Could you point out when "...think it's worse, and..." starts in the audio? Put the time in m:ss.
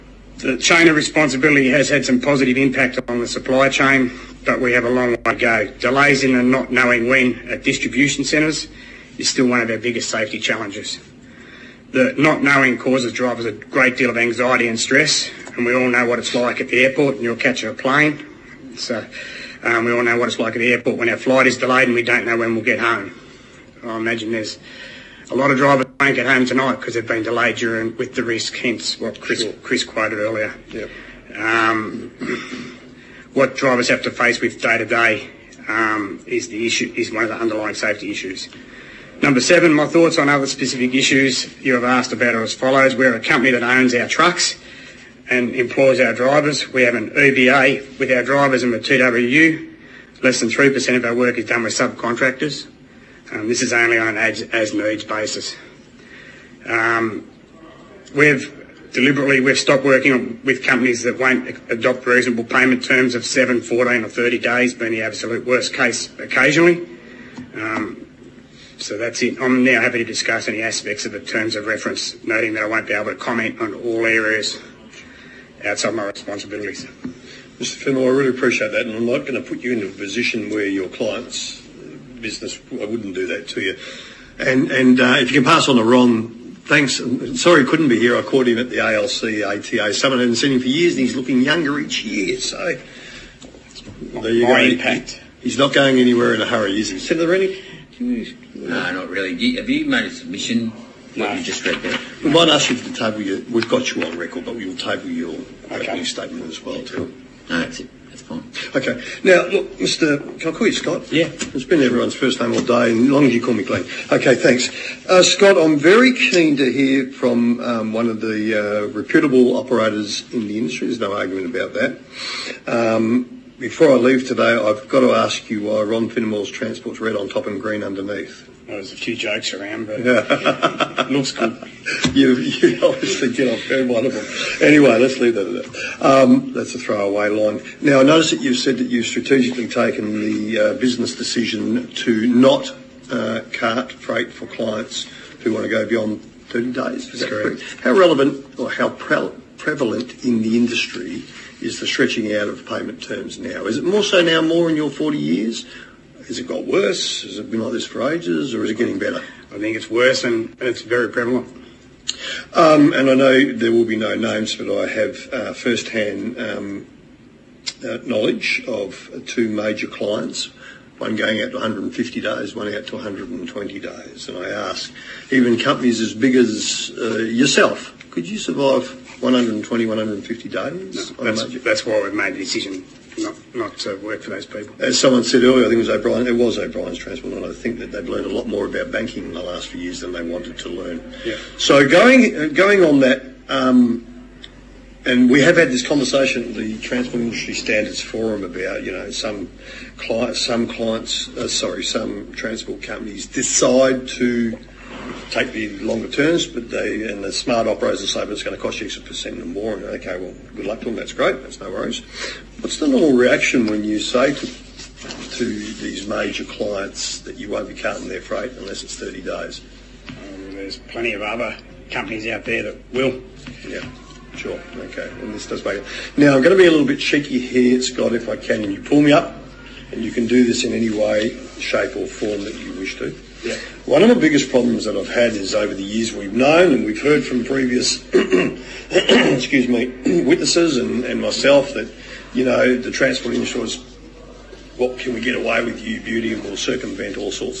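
2:39.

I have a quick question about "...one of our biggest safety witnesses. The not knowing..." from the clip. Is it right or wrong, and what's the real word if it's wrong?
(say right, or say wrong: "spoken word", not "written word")
wrong: "challenges", not "witnesses".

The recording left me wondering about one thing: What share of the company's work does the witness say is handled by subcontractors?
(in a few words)
Less than 3%.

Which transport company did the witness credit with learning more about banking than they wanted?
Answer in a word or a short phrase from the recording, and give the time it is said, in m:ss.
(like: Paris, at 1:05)
O'Brien's transport, at 3:06.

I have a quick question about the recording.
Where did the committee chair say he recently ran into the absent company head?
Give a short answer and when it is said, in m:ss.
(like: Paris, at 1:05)
ALC, at 1:28.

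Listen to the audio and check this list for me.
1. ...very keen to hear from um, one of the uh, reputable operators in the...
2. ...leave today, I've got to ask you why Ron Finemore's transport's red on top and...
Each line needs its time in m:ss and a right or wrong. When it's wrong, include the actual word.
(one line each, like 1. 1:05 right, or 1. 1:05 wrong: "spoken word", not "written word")
1. 1:55 right
2. 2:03 right.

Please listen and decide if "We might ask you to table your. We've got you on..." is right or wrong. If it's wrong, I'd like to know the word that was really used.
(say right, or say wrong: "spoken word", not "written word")
right.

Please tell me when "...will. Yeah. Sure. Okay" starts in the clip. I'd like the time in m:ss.
3:42.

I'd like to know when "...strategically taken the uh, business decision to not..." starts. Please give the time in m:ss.
2:19.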